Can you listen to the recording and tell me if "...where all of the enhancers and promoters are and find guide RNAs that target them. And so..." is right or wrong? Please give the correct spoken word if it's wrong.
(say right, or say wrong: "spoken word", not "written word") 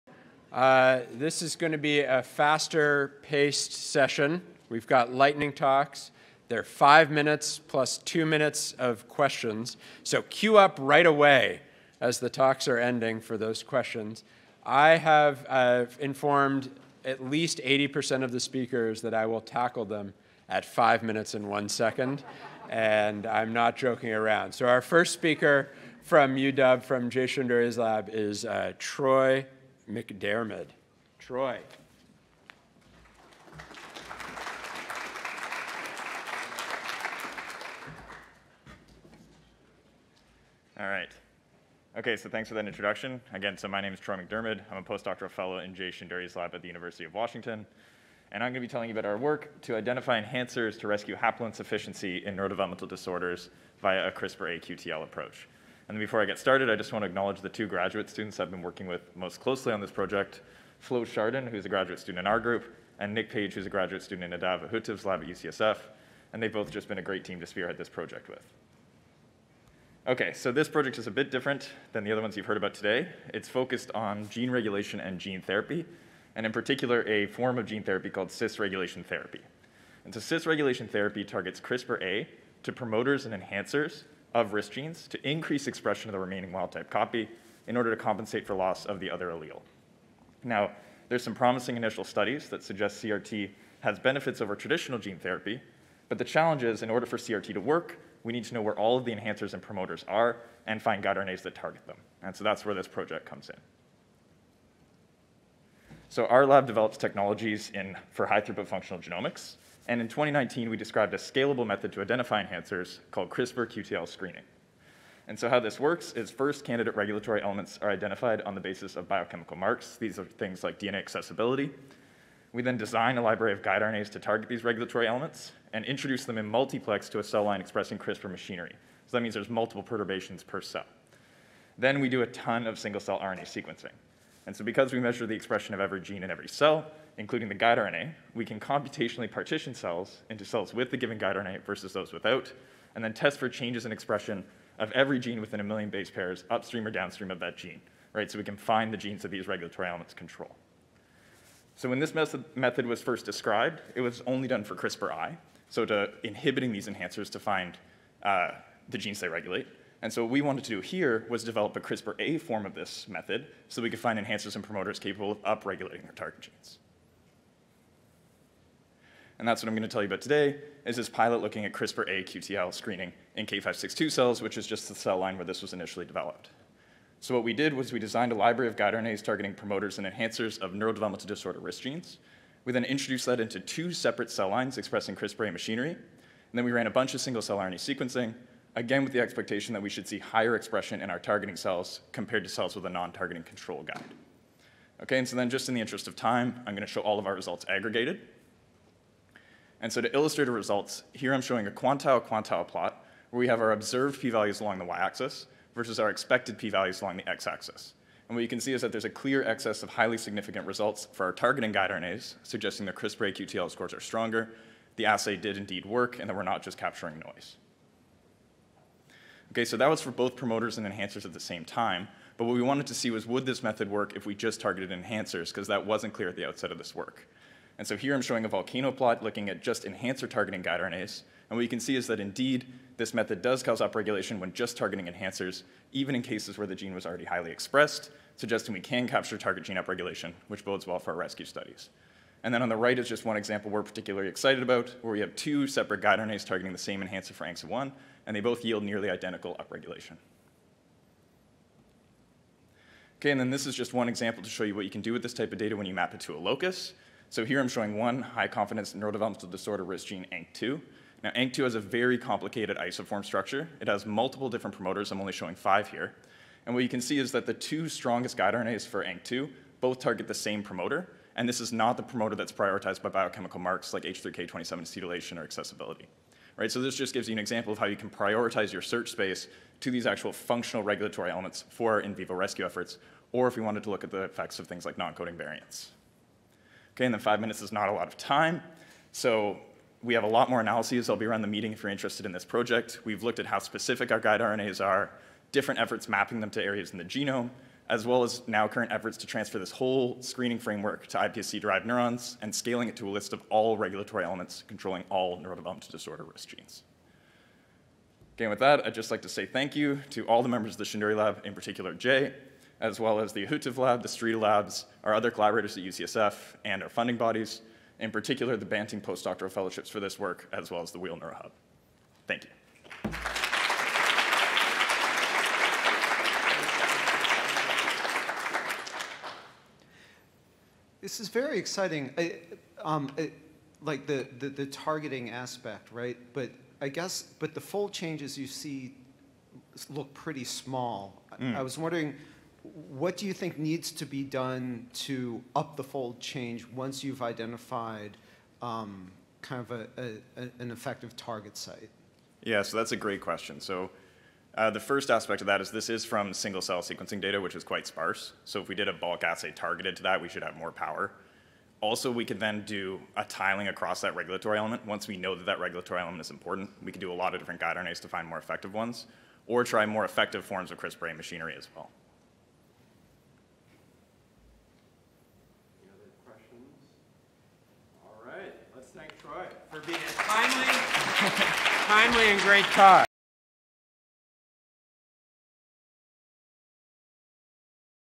right.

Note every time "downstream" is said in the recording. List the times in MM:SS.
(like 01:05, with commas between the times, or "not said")
02:26.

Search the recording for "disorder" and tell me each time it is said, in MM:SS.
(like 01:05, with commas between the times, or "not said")
00:52, 03:01, 04:19, 05:05.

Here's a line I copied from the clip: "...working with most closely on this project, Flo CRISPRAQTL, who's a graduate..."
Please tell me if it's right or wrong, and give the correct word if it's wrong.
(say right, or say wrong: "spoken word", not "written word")
wrong: "Chardon", not "CRISPRAQTL".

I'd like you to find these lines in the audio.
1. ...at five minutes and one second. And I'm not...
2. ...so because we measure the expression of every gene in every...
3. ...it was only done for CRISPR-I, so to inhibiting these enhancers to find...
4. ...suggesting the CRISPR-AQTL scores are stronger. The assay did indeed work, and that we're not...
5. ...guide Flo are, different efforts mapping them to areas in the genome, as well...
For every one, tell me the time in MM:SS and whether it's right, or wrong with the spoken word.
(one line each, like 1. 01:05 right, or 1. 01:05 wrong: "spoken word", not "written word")
1. 00:20 right
2. 02:14 right
3. 02:33 right
4. 03:32 right
5. 04:54 wrong: "RNAs", not "Flo".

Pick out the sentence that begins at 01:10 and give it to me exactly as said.
Okay, so this project is a bit different than the other ones you've heard about today.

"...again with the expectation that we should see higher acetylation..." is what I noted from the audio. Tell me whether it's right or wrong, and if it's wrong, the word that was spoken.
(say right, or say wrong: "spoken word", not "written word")
wrong: "expression", not "acetylation".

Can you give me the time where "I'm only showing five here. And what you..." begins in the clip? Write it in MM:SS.
04:25.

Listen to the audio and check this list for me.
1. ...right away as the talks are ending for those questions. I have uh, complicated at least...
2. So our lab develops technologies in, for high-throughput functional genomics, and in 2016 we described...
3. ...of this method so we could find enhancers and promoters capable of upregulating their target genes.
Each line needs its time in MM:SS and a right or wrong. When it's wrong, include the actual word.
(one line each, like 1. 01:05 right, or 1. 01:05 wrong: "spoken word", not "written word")
1. 00:10 wrong: "informed", not "complicated"
2. 01:46 wrong: "2019", not "2016"
3. 02:42 right.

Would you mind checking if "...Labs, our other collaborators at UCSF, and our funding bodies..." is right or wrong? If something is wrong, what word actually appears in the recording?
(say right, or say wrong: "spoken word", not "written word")
right.